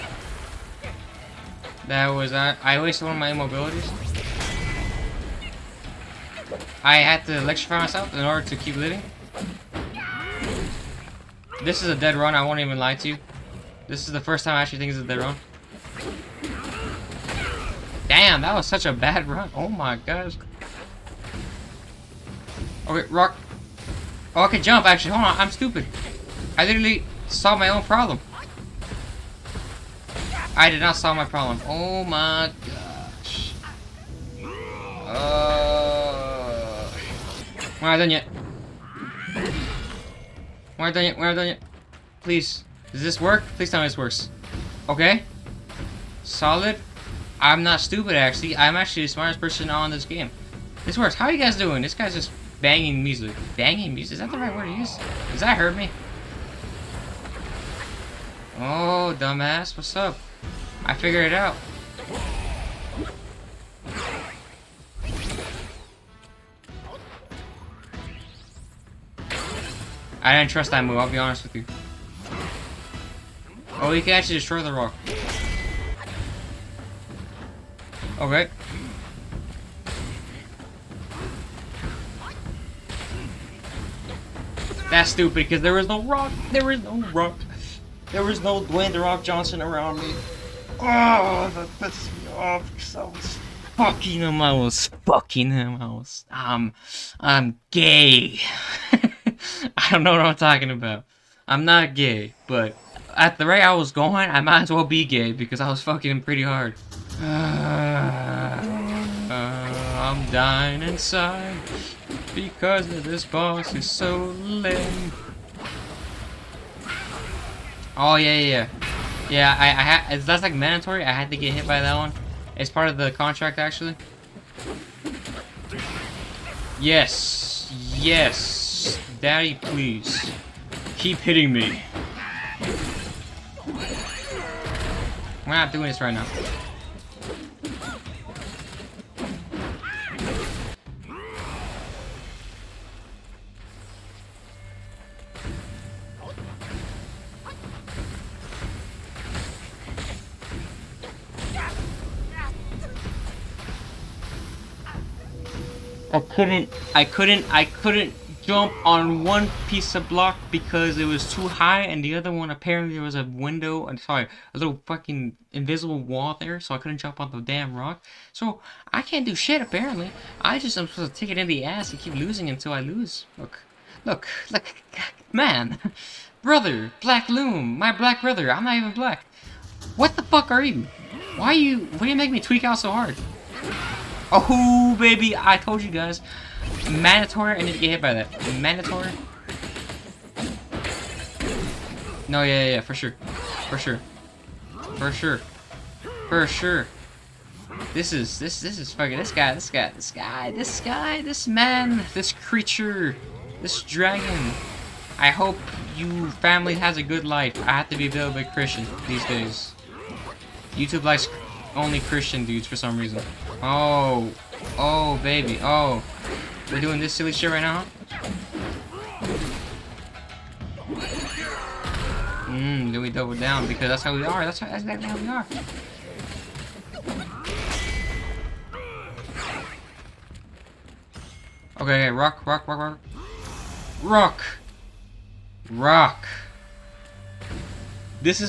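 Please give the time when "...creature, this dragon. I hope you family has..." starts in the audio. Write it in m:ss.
3:22.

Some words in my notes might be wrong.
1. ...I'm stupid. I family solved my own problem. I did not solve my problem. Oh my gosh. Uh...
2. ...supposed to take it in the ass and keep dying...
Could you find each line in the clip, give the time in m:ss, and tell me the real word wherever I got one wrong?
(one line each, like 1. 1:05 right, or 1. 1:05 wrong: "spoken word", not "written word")
1. 0:25 wrong: "literally", not "family"
2. 2:50 wrong: "losing", not "dying".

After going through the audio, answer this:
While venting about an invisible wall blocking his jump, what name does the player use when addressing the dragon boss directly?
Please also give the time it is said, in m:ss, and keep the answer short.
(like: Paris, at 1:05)
Black Loong, at 2:57.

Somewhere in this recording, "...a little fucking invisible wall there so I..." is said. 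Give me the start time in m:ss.
2:44.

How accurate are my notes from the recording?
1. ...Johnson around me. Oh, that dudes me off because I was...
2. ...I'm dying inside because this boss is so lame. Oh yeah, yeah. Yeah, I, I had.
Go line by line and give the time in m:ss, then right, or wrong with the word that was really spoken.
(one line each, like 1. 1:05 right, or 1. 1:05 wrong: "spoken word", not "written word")
1. 1:29 wrong: "pisses", not "dudes"
2. 1:50 right.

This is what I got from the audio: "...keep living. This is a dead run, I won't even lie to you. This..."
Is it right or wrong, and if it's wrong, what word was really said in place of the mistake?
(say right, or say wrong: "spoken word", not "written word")
right.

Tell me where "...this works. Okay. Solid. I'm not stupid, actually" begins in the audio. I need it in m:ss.
0:43.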